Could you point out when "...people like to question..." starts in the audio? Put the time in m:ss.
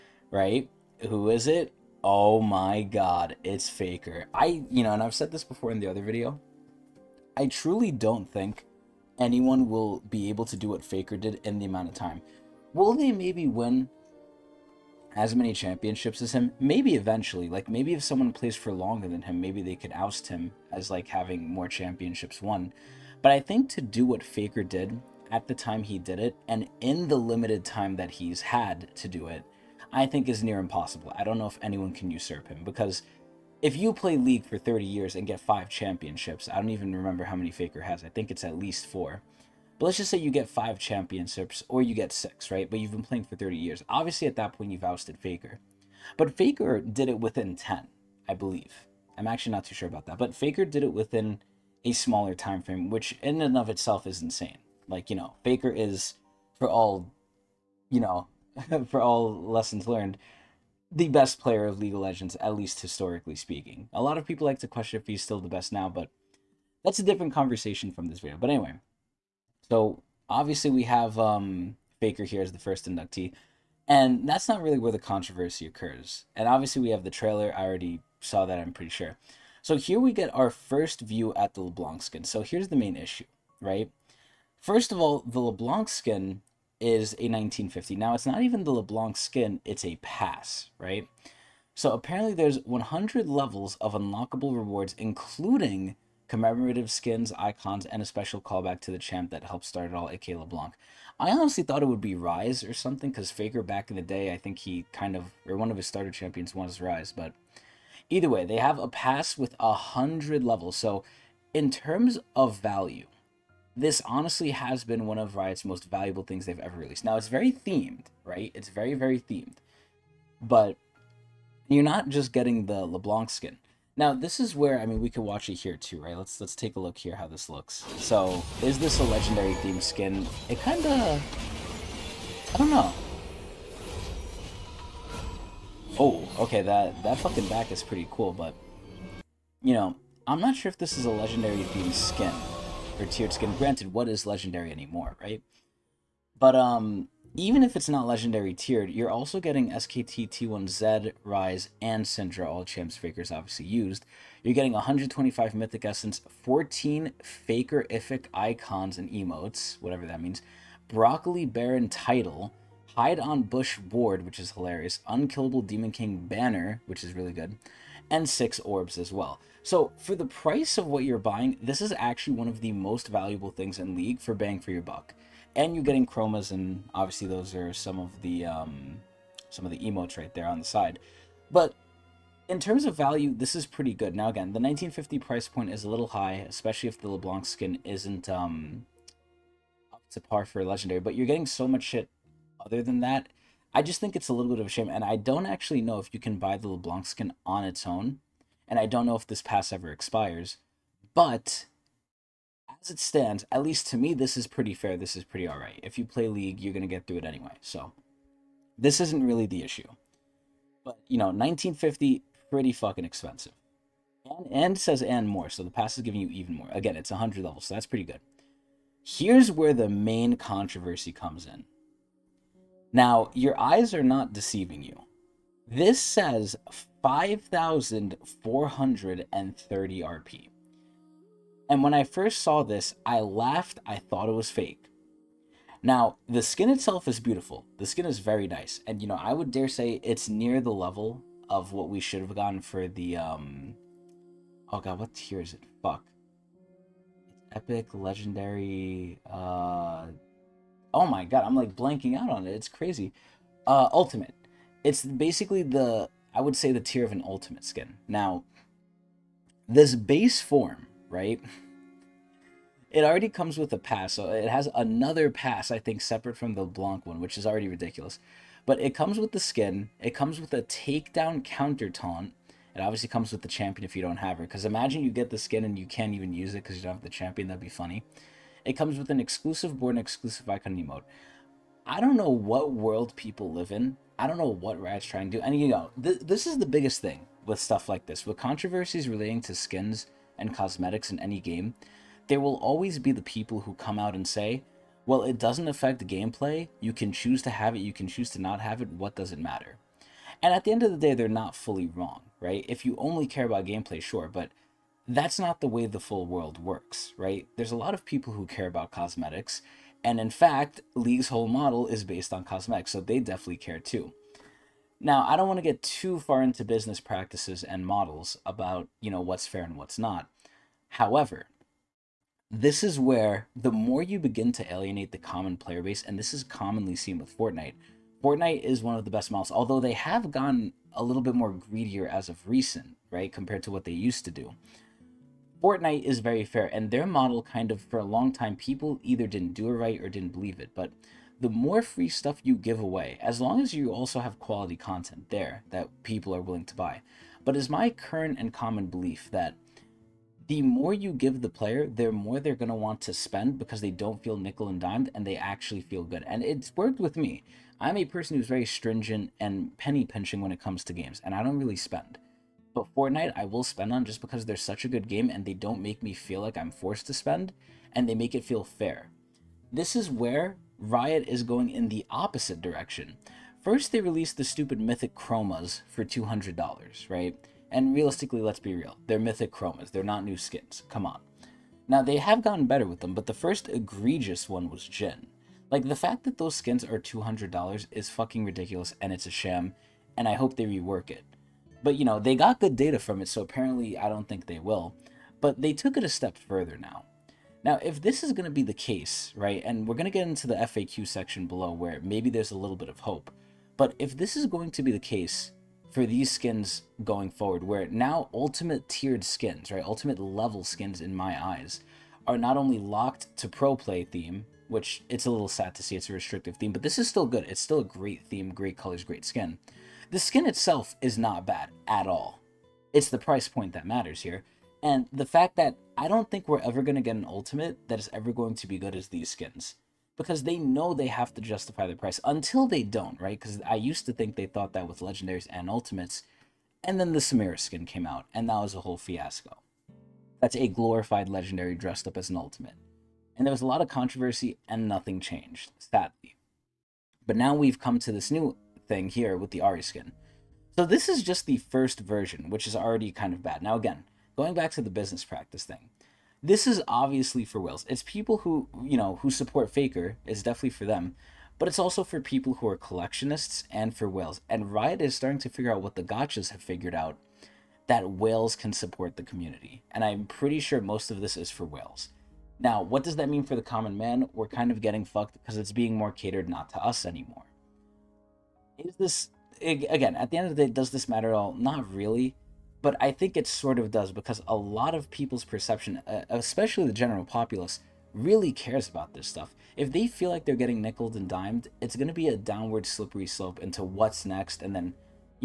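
1:04.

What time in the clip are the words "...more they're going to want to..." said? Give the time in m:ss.
5:52.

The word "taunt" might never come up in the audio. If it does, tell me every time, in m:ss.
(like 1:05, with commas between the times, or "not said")
4:31.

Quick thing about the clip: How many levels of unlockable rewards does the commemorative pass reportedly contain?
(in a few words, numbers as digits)
100.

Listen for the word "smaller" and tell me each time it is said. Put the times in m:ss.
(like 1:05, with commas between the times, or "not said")
0:51.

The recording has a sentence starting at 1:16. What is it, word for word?
And obviously we have the trailer.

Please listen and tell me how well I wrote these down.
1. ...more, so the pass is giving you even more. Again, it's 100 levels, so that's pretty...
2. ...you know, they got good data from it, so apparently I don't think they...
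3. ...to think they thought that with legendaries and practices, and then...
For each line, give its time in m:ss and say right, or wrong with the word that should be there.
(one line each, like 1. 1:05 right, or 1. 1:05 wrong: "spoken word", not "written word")
1. 3:35 right
2. 6:31 right
3. 7:14 wrong: "ultimates", not "practices".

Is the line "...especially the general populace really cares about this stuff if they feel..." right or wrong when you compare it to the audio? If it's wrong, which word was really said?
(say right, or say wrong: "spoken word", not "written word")
right.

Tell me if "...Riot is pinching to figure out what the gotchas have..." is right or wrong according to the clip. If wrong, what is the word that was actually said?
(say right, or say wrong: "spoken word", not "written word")
wrong: "starting", not "pinching".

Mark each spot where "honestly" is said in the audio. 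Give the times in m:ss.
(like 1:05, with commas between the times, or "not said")
1:41, 1:54.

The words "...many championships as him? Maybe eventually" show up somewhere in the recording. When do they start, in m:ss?
0:15.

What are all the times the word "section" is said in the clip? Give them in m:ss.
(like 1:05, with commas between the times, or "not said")
6:41.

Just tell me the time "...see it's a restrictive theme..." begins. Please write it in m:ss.
6:55.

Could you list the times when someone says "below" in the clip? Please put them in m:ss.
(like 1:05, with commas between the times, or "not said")
6:41.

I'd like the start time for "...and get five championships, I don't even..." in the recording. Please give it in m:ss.
0:35.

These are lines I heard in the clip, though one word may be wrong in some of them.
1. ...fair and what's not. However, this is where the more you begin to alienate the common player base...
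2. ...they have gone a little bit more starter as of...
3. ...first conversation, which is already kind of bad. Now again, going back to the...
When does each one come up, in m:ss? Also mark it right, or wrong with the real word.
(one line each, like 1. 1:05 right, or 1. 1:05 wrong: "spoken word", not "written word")
1. 5:19 right
2. 5:29 wrong: "greedier", not "starter"
3. 7:31 wrong: "version", not "conversation".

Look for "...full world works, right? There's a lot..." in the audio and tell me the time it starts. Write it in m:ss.
5:05.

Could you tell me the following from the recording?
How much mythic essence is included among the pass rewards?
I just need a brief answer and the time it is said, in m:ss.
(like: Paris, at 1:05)
125, at 2:34.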